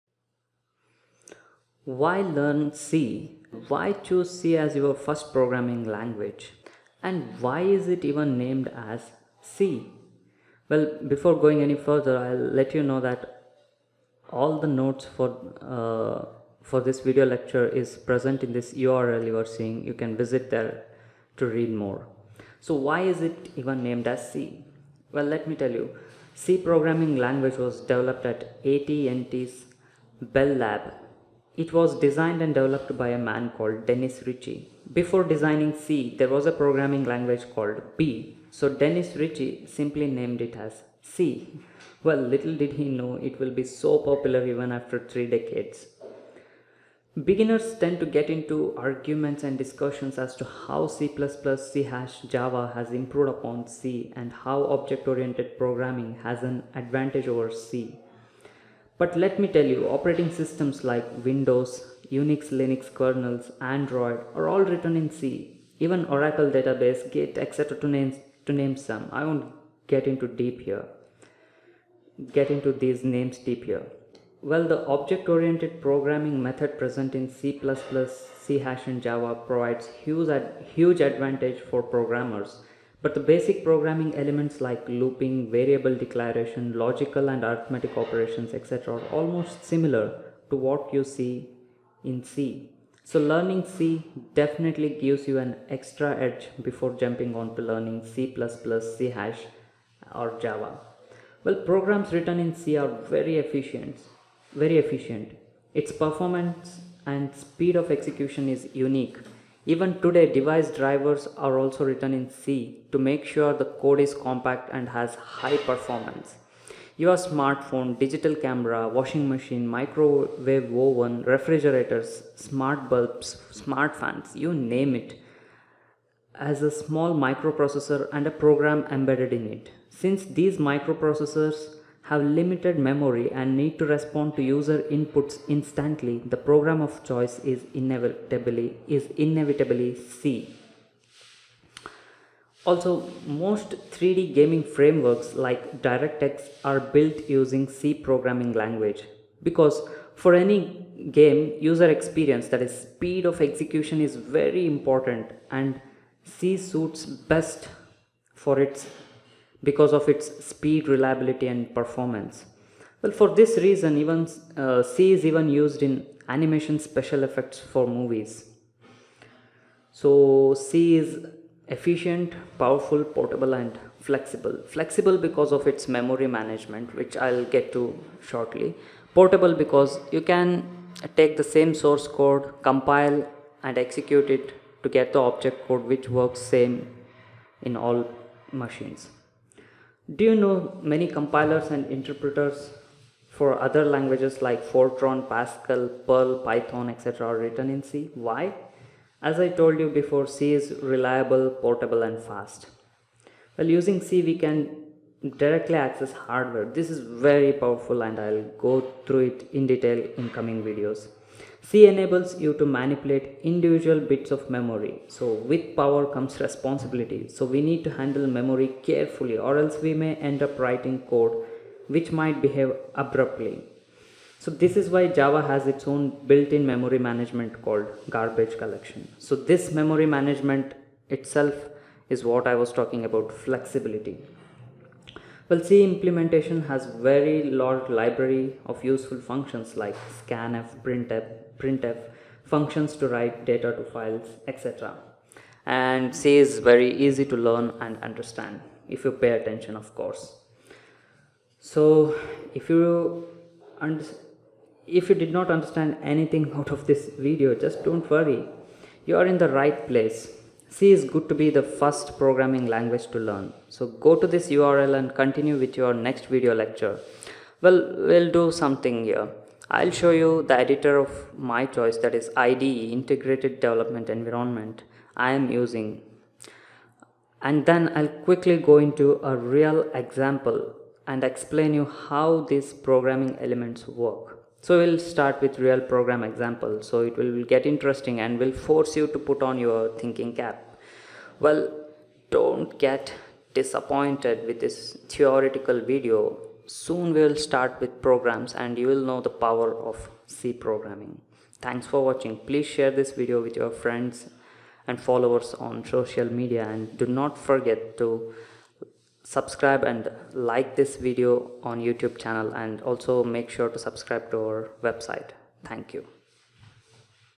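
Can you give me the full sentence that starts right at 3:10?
Do you know many compilers and interpreters for other languages like Fortran, Pascal, Perl, Python, etc.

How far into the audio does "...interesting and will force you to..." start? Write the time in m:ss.
4:47.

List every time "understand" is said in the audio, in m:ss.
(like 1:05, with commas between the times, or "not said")
4:08, 4:15.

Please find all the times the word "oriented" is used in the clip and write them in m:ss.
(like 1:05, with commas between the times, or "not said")
0:54, 1:14.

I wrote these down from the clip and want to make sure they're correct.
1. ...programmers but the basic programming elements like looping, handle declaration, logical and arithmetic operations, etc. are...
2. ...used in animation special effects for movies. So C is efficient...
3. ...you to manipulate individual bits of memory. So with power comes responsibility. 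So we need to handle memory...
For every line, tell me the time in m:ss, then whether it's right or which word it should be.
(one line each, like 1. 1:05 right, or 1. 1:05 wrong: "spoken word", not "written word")
1. 1:21 wrong: "variable", not "handle"
2. 2:45 right
3. 3:32 right.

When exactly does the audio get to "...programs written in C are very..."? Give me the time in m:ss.
1:41.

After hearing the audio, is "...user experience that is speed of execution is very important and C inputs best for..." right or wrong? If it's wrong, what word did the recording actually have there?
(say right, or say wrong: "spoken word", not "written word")
wrong: "suits", not "inputs".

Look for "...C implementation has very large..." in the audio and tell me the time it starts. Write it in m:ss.
3:55.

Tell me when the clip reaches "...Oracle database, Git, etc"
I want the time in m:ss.
1:06.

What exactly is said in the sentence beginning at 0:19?
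You can visit there to read more.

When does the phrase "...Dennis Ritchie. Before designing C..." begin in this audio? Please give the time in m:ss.
0:33.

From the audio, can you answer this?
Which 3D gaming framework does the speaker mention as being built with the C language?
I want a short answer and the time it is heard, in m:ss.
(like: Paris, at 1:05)
DirectX, at 2:25.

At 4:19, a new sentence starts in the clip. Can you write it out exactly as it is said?
You are in the right place C is good to be the first programming language to learn.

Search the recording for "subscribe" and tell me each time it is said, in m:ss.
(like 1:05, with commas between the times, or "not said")
5:09, 5:13.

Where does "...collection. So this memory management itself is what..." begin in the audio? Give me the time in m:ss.
3:48.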